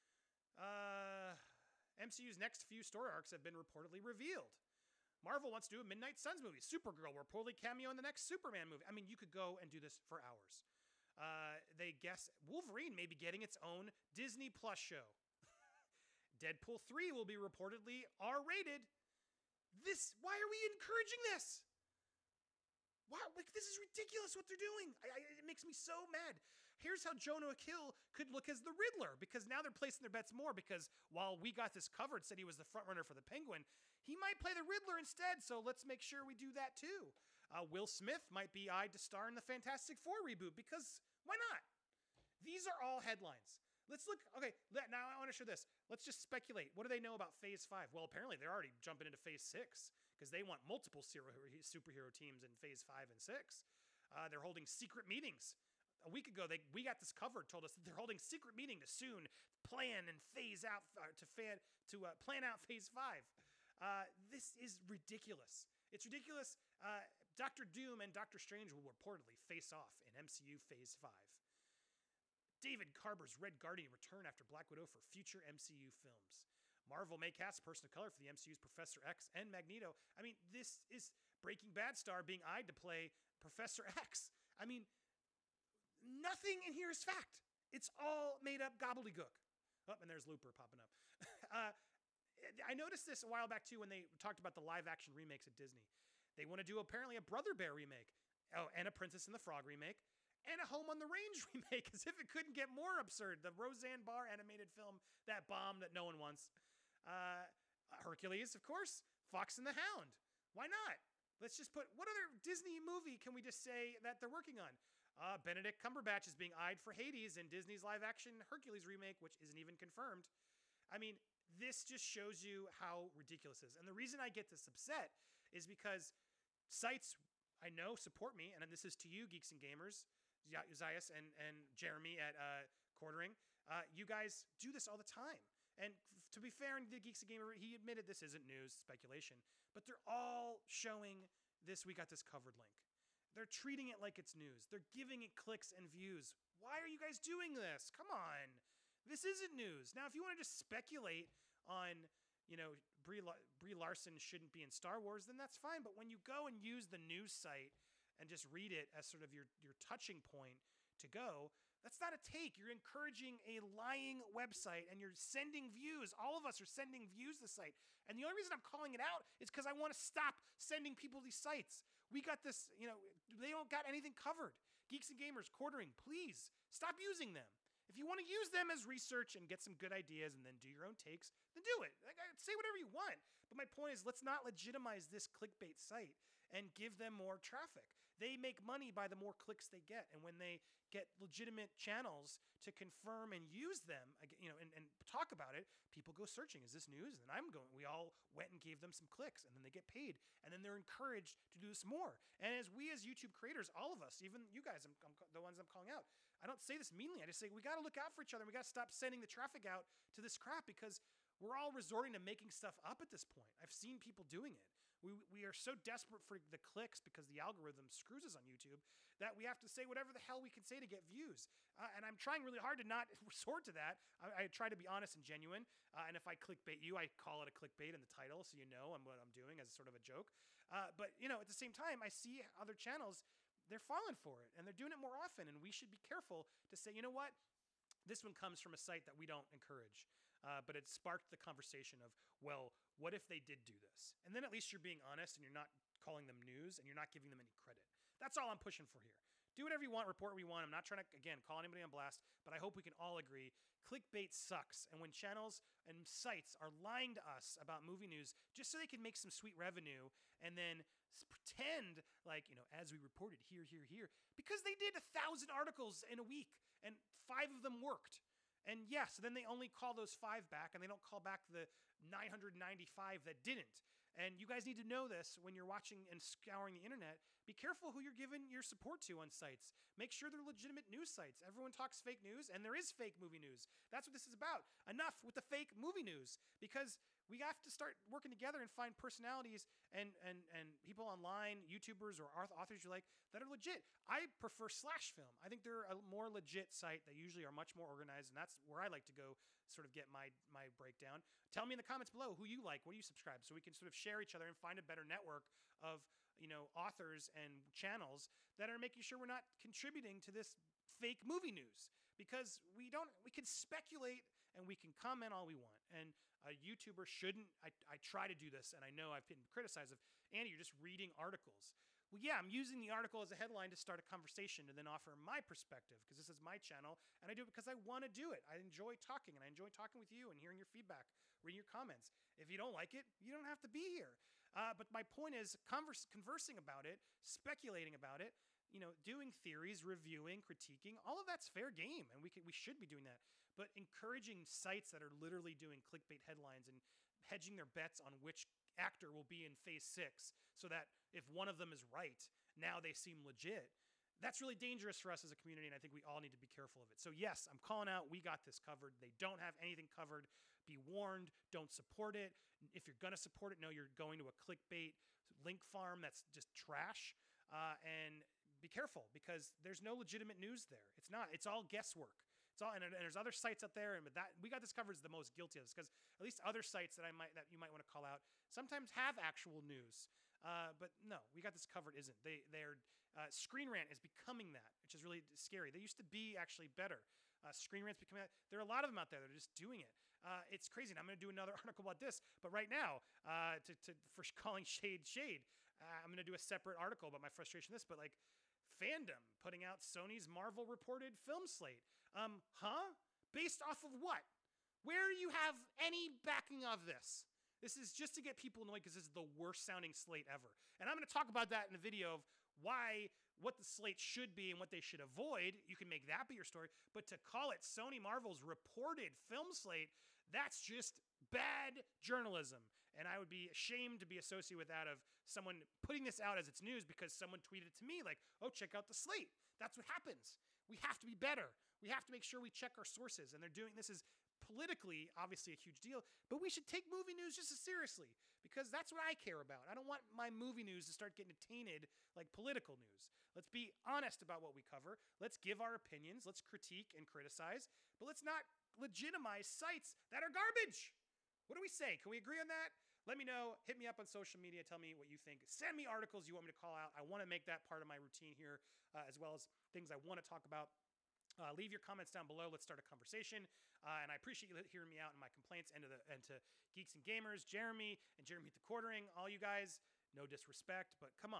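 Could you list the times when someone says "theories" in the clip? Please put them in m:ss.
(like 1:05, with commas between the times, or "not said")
5:39.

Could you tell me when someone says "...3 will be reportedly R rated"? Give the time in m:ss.
0:16.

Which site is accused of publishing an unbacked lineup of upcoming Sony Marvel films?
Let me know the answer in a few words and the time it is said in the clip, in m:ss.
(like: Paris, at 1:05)
fandom, at 6:38.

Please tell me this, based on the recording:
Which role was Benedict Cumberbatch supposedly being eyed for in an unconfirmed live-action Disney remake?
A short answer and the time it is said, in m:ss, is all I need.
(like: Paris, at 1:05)
Hades, at 1:56.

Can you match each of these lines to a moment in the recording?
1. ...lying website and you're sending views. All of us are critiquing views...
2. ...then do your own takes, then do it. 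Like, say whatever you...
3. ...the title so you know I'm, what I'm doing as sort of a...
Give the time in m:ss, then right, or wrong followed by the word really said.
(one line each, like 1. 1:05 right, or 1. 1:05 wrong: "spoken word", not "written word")
1. 2:43 wrong: "sending", not "critiquing"
2. 3:00 right
3. 3:48 right.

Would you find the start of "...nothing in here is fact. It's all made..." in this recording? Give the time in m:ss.
1:26.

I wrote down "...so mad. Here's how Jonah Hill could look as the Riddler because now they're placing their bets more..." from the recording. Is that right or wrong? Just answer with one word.
right.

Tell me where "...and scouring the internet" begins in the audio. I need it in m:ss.
4:36.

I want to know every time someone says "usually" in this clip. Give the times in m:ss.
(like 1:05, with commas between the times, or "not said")
4:57.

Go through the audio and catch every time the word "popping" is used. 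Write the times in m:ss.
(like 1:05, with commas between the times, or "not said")
1:30.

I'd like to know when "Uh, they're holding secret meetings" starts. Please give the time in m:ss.
0:54.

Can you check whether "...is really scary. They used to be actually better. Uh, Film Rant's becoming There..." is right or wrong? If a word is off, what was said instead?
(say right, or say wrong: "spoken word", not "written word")
wrong: "Screen", not "Film".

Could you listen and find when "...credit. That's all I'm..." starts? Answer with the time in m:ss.
4:07.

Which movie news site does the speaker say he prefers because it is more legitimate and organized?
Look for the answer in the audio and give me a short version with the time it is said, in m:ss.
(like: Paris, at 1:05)
Slash Film, at 4:54.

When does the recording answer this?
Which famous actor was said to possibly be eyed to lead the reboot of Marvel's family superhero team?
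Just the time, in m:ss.
0:37.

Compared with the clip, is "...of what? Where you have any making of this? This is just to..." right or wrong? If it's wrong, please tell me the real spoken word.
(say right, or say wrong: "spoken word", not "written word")
wrong: "backing", not "making".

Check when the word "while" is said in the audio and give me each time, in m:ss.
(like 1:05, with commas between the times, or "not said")
0:31, 1:33.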